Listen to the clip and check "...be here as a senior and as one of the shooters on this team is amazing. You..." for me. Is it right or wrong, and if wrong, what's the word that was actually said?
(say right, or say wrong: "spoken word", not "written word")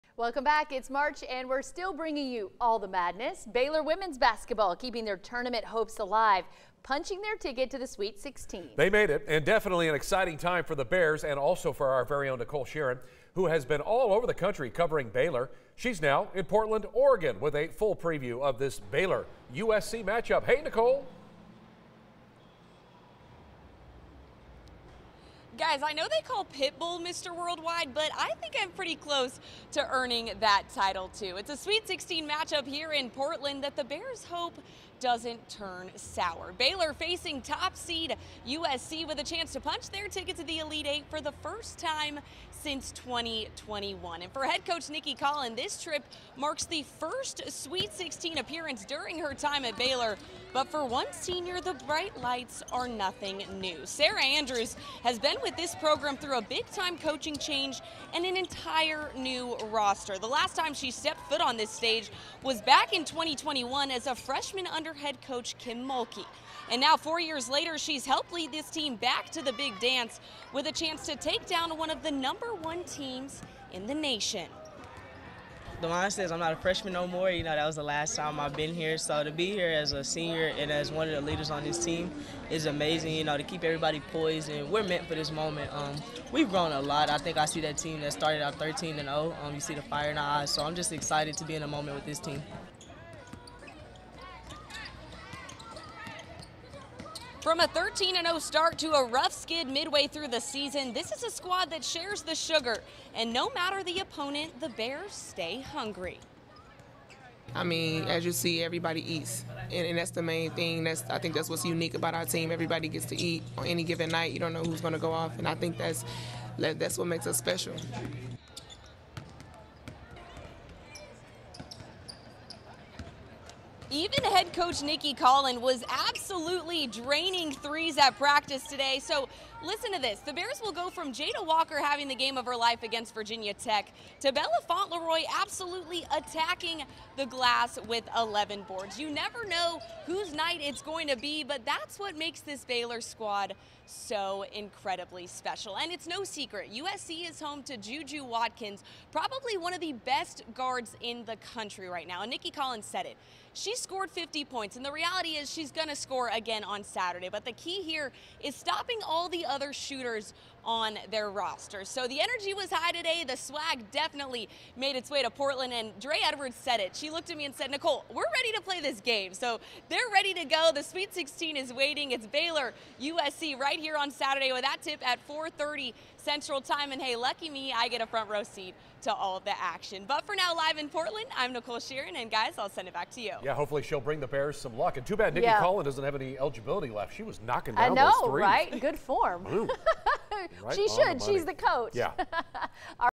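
wrong: "leaders", not "shooters".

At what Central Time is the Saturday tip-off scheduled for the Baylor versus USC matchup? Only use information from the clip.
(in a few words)
4:30.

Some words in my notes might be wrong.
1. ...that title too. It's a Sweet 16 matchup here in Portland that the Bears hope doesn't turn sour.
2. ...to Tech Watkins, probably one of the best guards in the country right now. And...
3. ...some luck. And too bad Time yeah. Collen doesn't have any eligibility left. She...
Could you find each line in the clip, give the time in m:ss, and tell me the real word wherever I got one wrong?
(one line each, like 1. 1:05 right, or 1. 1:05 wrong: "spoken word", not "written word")
1. 0:30 right
2. 2:27 wrong: "Juju", not "Tech"
3. 3:04 wrong: "Nicki", not "Time".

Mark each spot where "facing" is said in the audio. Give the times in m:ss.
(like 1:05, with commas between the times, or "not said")
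0:36.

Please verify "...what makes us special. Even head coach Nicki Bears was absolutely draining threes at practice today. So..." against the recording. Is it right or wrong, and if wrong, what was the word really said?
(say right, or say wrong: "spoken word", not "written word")
wrong: "Collen", not "Bears".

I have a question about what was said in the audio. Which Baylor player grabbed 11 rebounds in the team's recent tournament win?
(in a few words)
Bella Fontleroy.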